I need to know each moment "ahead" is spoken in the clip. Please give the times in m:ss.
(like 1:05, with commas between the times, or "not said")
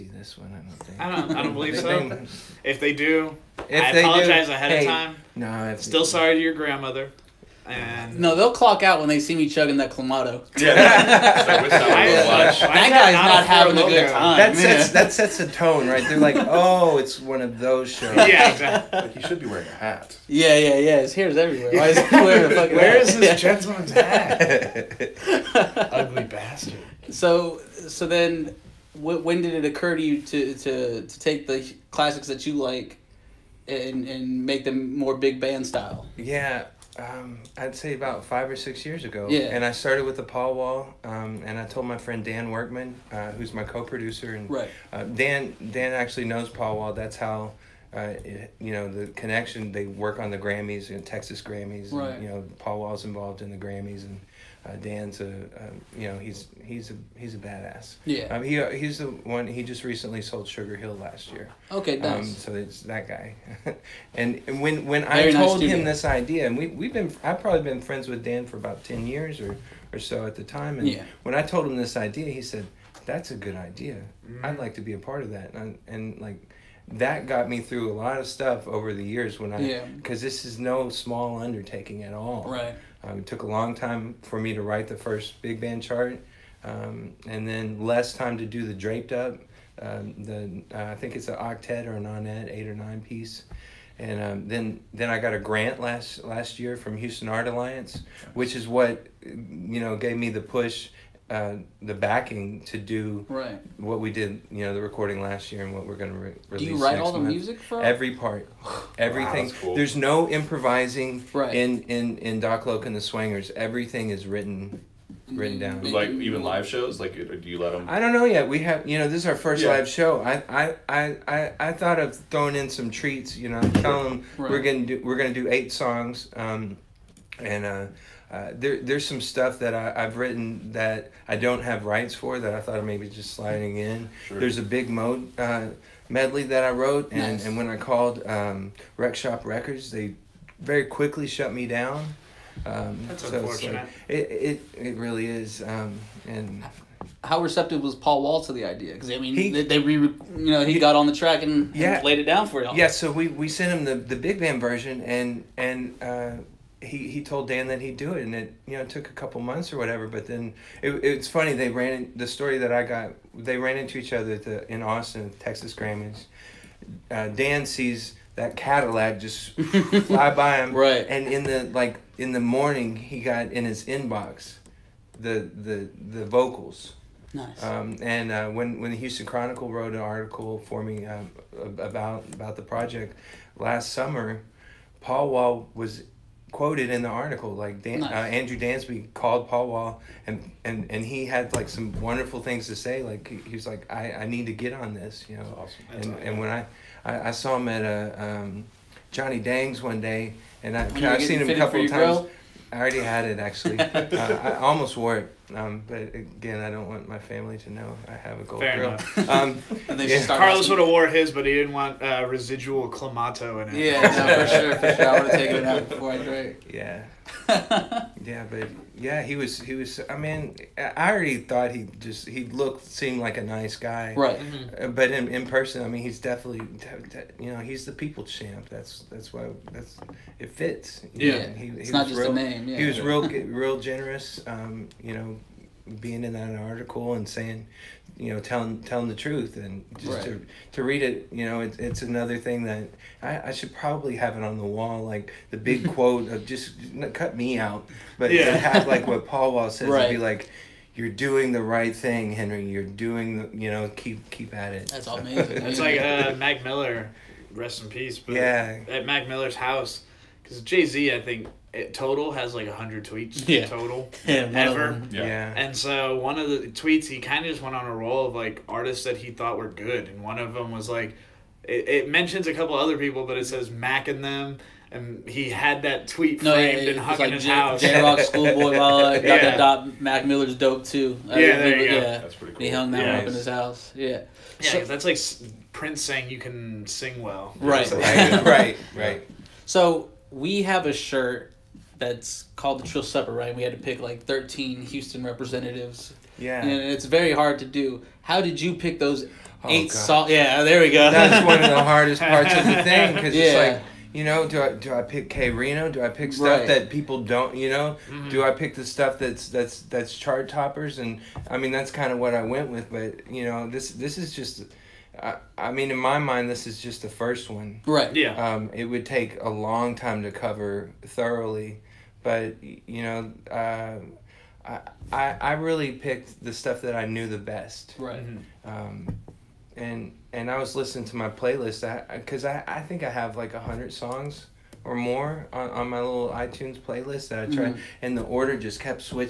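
0:04.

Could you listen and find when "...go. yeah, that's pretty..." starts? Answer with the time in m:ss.
4:41.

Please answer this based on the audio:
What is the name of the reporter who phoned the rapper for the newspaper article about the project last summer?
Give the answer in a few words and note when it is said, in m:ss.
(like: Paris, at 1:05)
Andrew Dansby, at 3:08.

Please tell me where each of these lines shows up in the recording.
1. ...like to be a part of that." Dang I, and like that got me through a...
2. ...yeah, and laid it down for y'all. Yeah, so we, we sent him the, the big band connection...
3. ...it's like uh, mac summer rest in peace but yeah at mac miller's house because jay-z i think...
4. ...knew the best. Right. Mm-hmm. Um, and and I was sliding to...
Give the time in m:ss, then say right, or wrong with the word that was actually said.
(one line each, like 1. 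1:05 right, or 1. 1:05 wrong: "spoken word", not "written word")
1. 1:14 wrong: "And", not "Dang"
2. 2:31 wrong: "version", not "connection"
3. 4:15 wrong: "miller", not "summer"
4. 5:27 wrong: "listening", not "sliding".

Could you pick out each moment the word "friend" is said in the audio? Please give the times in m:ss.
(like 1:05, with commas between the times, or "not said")
0:41, 1:07.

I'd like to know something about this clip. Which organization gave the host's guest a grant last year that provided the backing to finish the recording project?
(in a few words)
Houston Art Alliance.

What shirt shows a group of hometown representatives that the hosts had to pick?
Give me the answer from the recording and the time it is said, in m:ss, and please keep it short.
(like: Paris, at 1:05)
Trill Supper, at 4:52.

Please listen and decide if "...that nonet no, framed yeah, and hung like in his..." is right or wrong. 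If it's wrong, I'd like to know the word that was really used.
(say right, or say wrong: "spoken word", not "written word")
wrong: "tweet", not "nonet".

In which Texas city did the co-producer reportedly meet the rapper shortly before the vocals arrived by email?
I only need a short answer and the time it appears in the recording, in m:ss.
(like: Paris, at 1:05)
Austin, at 2:44.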